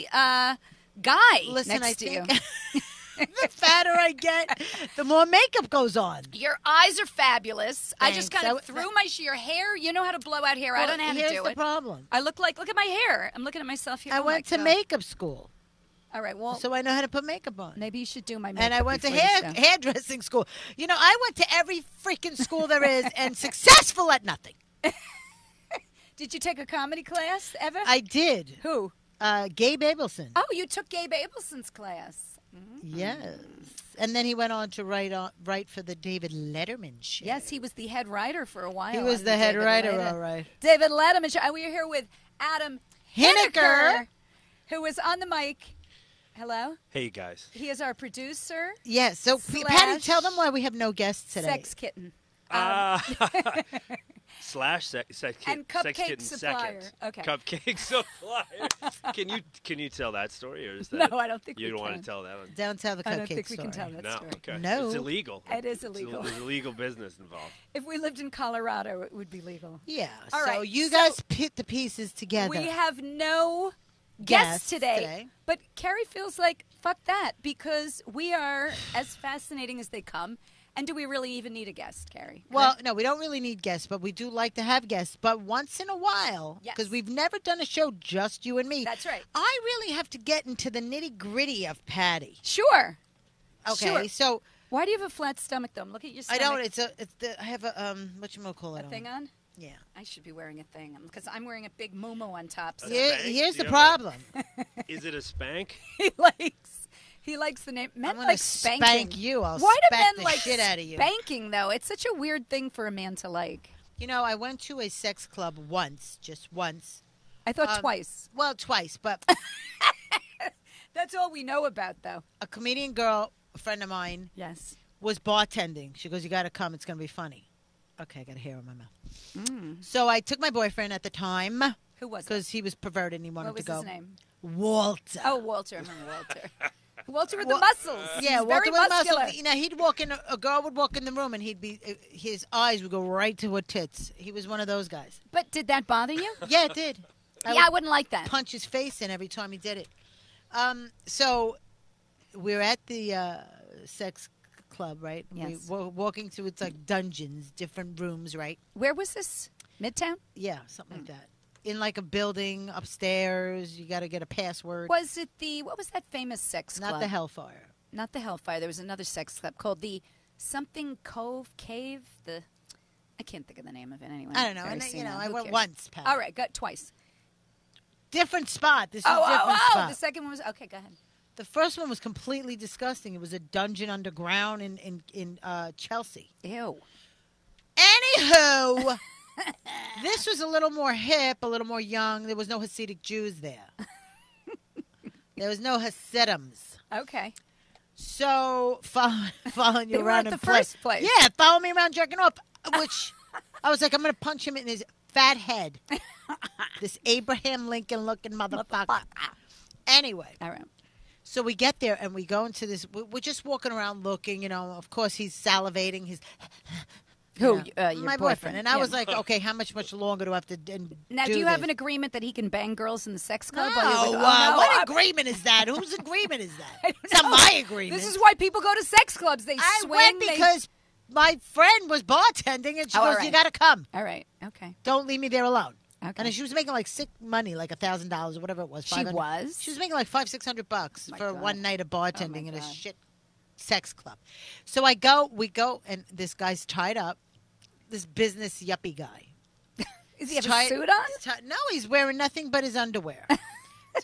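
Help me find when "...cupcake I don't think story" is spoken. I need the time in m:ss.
1:03.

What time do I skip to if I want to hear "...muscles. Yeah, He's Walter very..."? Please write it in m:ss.
2:17.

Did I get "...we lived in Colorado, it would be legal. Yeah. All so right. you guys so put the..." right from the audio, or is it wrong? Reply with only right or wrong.
right.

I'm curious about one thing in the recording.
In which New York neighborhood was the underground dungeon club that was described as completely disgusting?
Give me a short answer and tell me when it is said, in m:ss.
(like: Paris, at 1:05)
Chelsea, at 3:05.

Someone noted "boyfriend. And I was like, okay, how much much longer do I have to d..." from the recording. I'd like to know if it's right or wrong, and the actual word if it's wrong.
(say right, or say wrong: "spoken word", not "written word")
right.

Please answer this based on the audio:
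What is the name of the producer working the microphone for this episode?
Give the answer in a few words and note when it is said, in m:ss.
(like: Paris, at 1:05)
Adam Hinnaker, at 0:42.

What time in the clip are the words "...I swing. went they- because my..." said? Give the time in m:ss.
3:49.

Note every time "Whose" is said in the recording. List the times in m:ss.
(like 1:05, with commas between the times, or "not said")
3:45.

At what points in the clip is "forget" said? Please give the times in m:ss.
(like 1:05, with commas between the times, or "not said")
not said.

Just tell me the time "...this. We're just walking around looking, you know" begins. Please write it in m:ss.
3:32.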